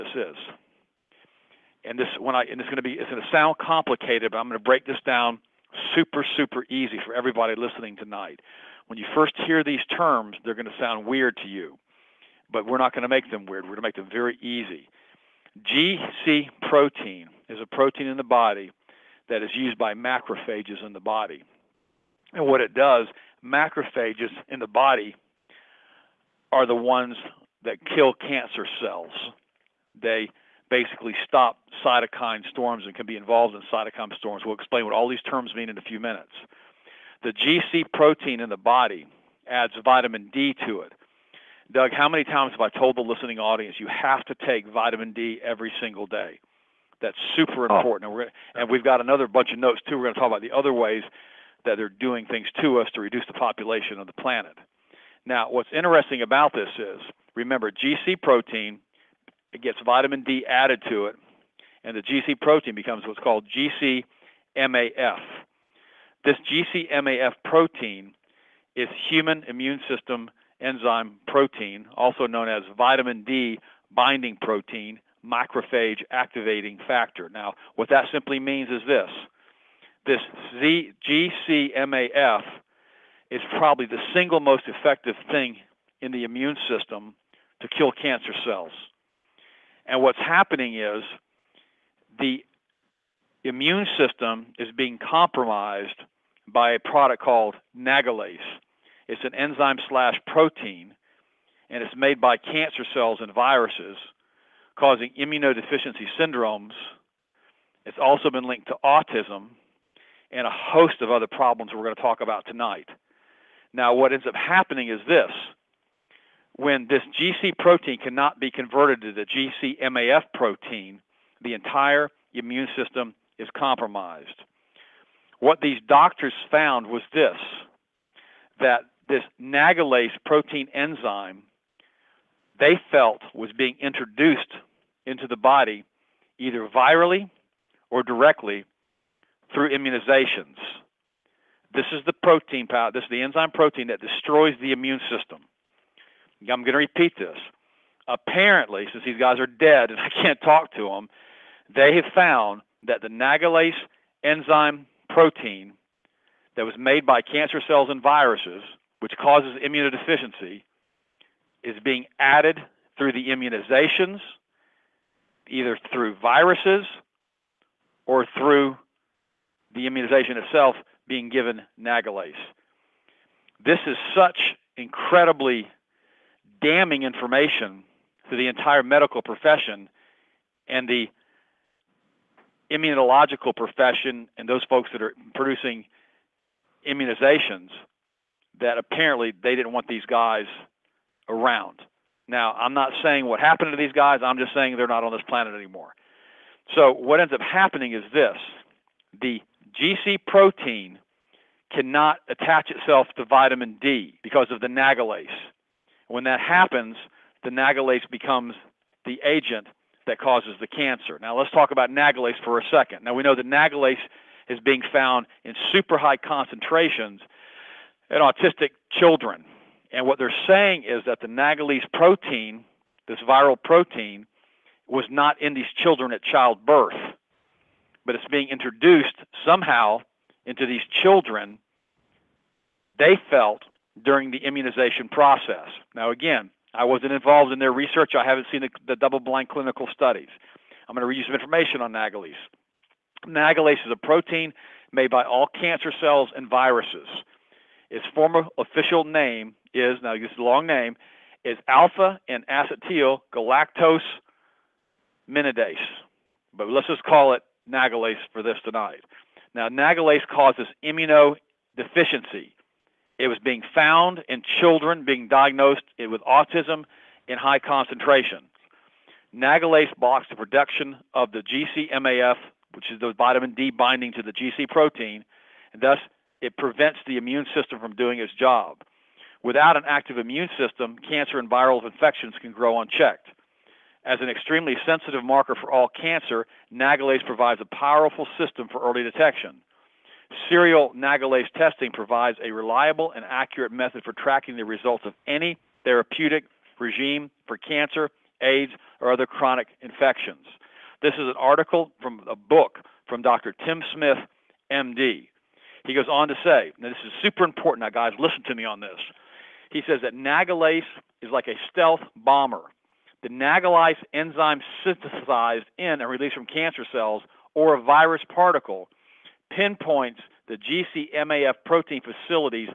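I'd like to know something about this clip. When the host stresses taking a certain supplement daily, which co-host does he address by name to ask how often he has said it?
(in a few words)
Doug.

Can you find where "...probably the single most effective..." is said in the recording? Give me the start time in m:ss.
1:23.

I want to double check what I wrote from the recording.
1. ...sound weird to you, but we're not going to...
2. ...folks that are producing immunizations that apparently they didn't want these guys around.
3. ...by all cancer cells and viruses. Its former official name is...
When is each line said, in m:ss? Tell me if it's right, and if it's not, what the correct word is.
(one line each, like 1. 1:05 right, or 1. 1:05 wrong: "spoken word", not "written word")
1. 0:10 right
2. 3:04 right
3. 4:05 right.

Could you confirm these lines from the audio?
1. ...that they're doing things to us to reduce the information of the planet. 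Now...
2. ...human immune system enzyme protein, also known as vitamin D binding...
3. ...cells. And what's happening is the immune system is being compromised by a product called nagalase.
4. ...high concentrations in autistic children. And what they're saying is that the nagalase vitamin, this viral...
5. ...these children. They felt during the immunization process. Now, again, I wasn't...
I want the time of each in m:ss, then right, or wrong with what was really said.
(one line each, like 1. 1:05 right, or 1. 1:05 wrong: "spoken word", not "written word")
1. 0:51 wrong: "population", not "information"
2. 1:09 right
3. 1:28 right
4. 3:35 wrong: "protein", not "vitamin"
5. 3:50 right.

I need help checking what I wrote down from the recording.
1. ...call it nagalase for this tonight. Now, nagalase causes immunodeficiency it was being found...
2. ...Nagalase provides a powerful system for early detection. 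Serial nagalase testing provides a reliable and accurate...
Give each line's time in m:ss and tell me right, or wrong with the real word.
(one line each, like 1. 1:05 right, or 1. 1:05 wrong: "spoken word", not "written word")
1. 4:17 right
2. 4:46 right.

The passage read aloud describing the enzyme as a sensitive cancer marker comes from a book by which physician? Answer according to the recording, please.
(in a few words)
Dr. Tim Smith.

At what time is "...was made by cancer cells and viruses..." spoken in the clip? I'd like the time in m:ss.
2:36.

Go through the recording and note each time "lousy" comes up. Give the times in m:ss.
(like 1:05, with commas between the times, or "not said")
not said.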